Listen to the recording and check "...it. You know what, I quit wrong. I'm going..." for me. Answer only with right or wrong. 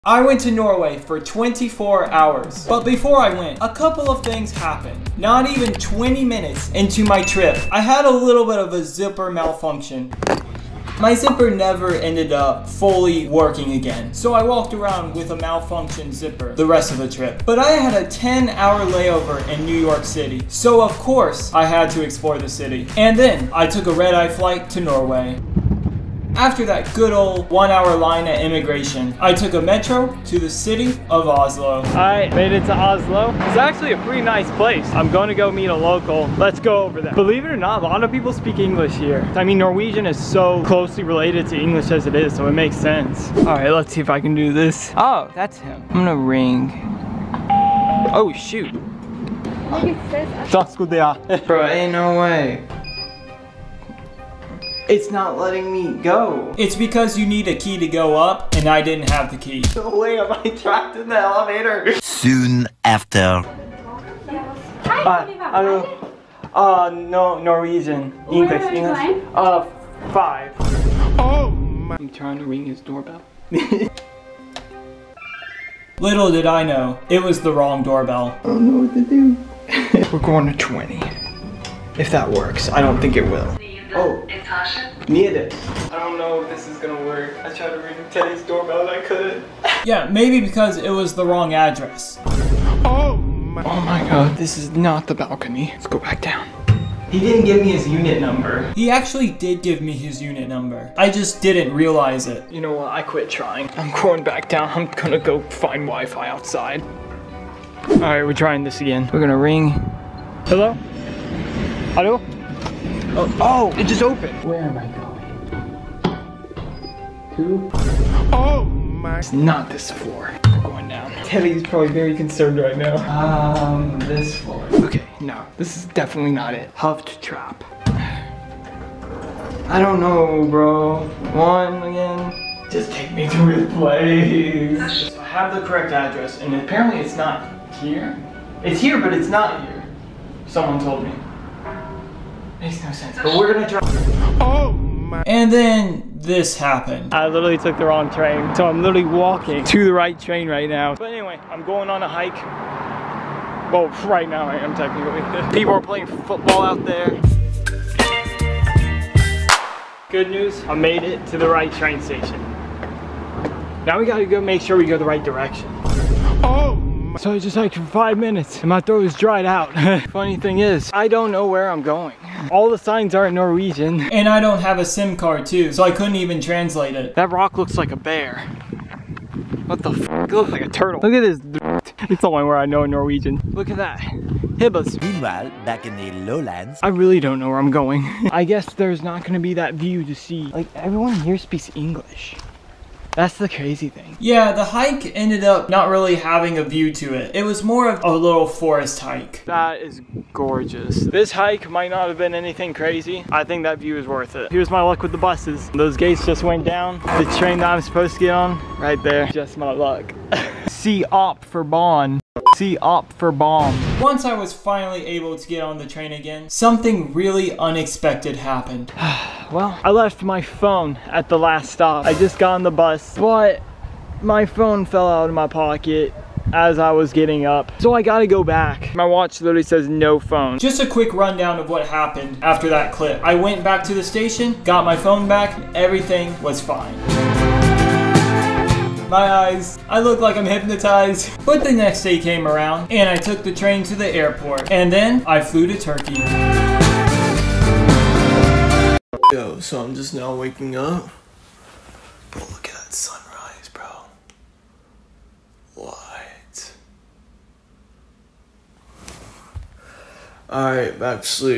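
wrong.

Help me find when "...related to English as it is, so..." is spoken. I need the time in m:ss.
0:41.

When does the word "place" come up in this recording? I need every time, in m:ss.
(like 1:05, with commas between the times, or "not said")
0:34, 2:13.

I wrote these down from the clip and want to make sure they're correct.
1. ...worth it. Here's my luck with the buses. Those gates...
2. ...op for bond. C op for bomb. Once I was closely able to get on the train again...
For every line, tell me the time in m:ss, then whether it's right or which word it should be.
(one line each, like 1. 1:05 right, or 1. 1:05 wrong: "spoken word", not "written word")
1. 3:24 right
2. 3:31 wrong: "finally", not "closely".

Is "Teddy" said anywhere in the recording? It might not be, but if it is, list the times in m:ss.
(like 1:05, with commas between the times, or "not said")
1:28, 2:01.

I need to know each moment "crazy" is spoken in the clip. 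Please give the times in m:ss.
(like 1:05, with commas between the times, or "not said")
3:13, 3:22.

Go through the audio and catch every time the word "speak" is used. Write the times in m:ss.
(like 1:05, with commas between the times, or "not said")
0:38, 3:11.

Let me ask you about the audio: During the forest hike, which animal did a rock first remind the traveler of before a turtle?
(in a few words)
Bear.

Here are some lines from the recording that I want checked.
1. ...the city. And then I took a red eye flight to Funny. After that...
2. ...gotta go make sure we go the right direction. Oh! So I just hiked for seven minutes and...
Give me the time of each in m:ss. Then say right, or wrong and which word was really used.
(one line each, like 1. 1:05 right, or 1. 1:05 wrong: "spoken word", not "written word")
1. 0:22 wrong: "Norway", not "Funny"
2. 2:44 wrong: "five", not "seven".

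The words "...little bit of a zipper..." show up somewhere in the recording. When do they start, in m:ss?
0:08.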